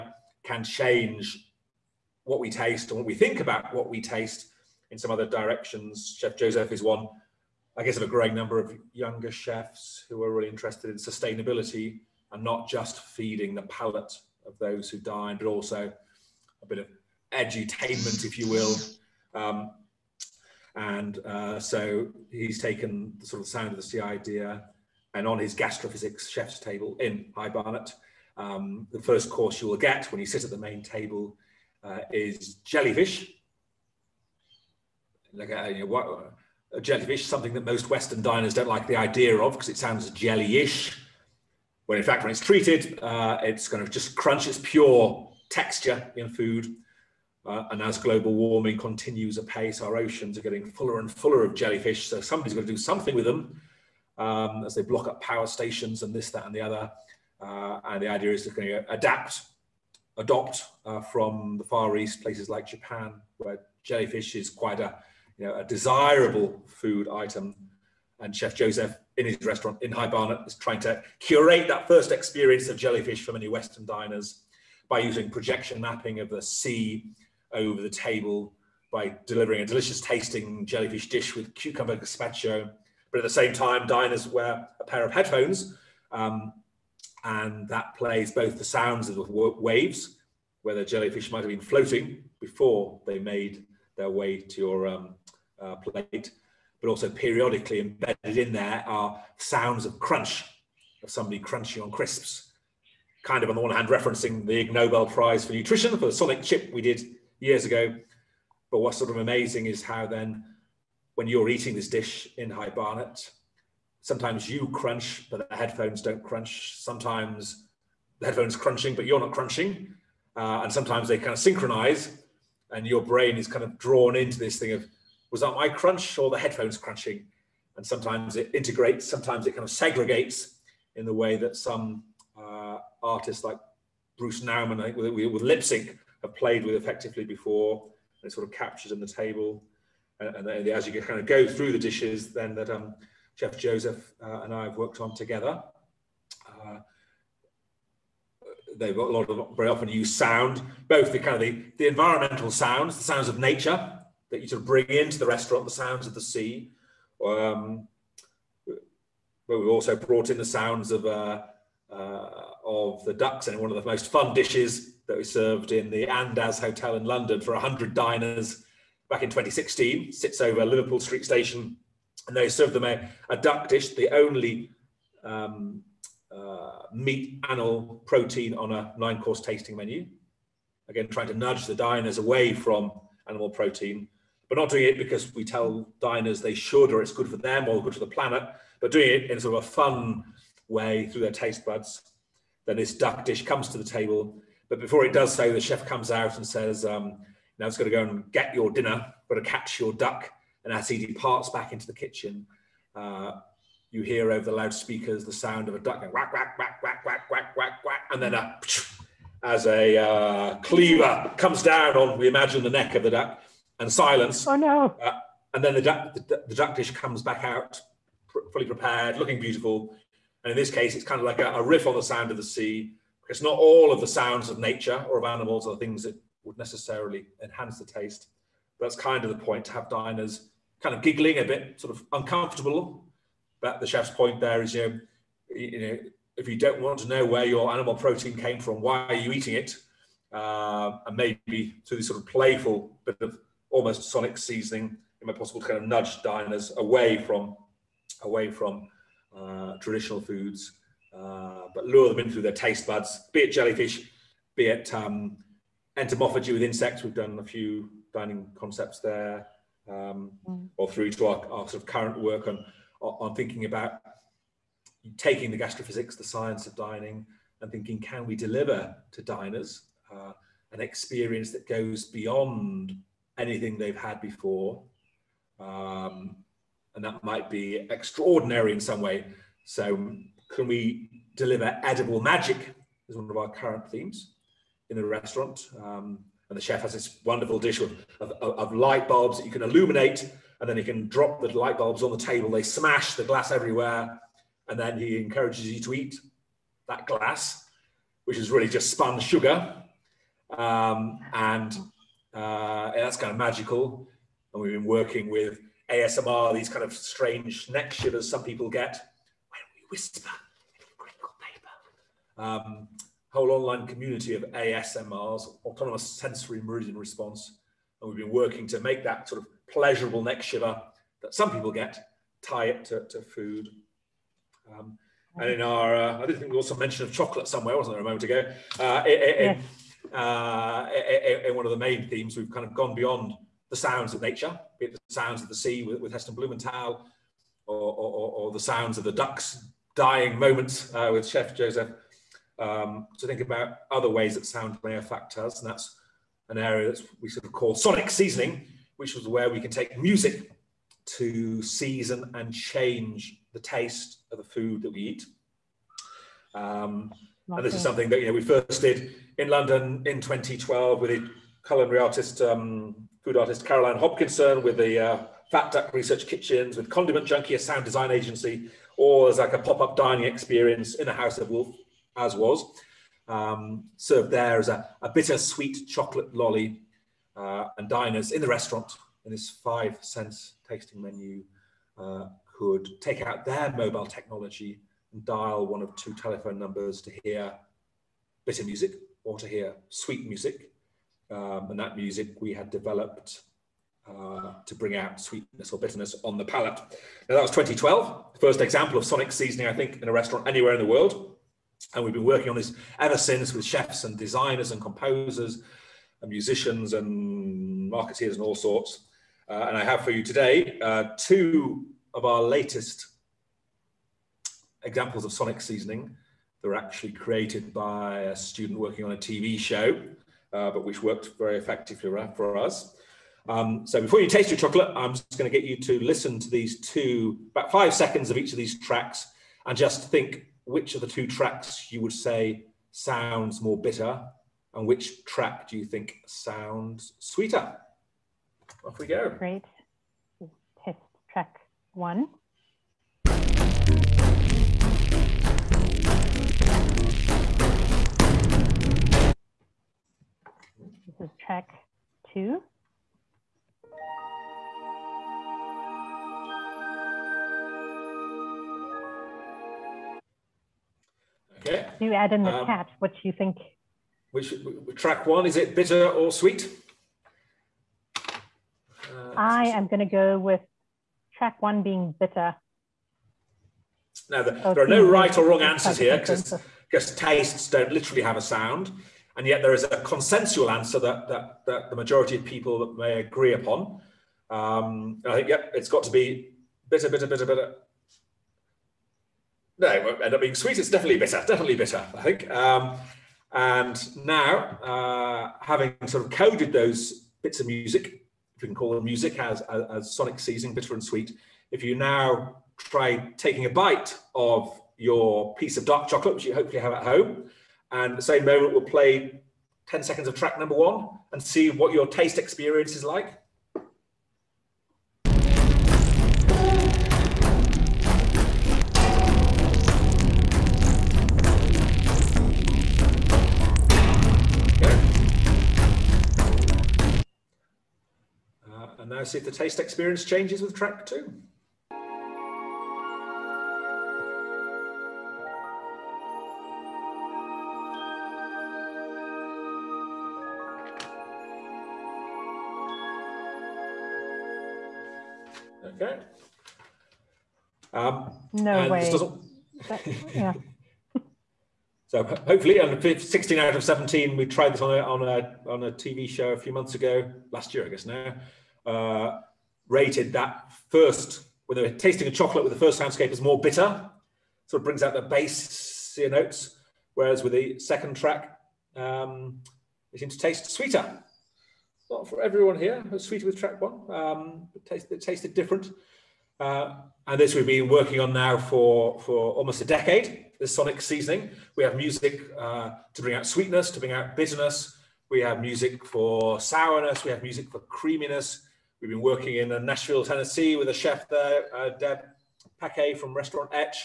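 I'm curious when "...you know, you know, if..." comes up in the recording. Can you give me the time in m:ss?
3:54.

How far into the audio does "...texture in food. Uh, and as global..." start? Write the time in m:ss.
0:45.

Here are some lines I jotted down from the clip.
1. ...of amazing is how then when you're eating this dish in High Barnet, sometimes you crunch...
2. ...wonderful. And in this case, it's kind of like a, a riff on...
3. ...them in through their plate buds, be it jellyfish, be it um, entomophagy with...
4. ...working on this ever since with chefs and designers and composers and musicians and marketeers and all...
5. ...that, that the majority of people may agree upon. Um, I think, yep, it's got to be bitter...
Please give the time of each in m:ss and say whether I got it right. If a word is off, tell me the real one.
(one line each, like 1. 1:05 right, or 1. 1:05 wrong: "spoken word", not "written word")
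1. 1:49 right
2. 3:39 wrong: "beautiful", not "wonderful"
3. 4:12 wrong: "taste", not "plate"
4. 6:42 right
5. 8:01 right.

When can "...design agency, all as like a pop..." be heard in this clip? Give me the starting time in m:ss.
6:07.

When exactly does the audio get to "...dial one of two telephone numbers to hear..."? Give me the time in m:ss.
6:25.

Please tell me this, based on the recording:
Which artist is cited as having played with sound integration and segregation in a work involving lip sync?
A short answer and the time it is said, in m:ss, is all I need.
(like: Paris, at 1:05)
Bruce Nauman, at 2:14.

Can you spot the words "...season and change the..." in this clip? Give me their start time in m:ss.
5:51.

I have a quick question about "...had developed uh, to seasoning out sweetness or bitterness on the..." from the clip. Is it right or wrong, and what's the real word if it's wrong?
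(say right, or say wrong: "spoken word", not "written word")
wrong: "bring", not "seasoning".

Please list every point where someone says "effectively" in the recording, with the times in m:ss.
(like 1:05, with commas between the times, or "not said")
2:16, 7:01.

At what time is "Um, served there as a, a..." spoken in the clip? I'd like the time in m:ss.
6:13.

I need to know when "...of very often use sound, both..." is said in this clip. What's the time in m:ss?
2:29.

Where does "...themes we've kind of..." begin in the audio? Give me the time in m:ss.
5:32.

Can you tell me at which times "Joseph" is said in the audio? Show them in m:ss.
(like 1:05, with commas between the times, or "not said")
0:06, 1:08, 2:23, 5:41.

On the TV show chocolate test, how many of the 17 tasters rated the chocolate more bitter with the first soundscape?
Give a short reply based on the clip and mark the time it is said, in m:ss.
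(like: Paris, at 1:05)
16, at 9:13.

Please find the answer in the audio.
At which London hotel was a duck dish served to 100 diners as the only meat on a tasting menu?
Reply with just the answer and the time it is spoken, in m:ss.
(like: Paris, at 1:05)
Andaz Hotel, at 2:46.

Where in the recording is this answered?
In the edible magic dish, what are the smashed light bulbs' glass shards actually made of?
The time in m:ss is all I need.
4:58.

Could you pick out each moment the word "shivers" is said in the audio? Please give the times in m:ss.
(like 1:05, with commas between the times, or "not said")
5:07, 5:20.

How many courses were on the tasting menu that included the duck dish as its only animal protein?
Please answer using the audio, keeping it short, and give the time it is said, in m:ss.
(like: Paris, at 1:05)
9, at 2:58.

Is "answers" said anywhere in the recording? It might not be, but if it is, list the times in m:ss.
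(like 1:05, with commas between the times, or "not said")
7:55, 8:00.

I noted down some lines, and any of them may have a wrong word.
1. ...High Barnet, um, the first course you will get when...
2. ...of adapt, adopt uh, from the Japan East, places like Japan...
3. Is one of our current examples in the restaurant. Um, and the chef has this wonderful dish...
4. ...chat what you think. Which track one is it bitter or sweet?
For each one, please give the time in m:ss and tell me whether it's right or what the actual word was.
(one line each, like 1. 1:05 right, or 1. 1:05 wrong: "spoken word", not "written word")
1. 0:27 right
2. 0:58 wrong: "Far", not "Japan"
3. 4:43 wrong: "themes", not "examples"
4. 7:42 right.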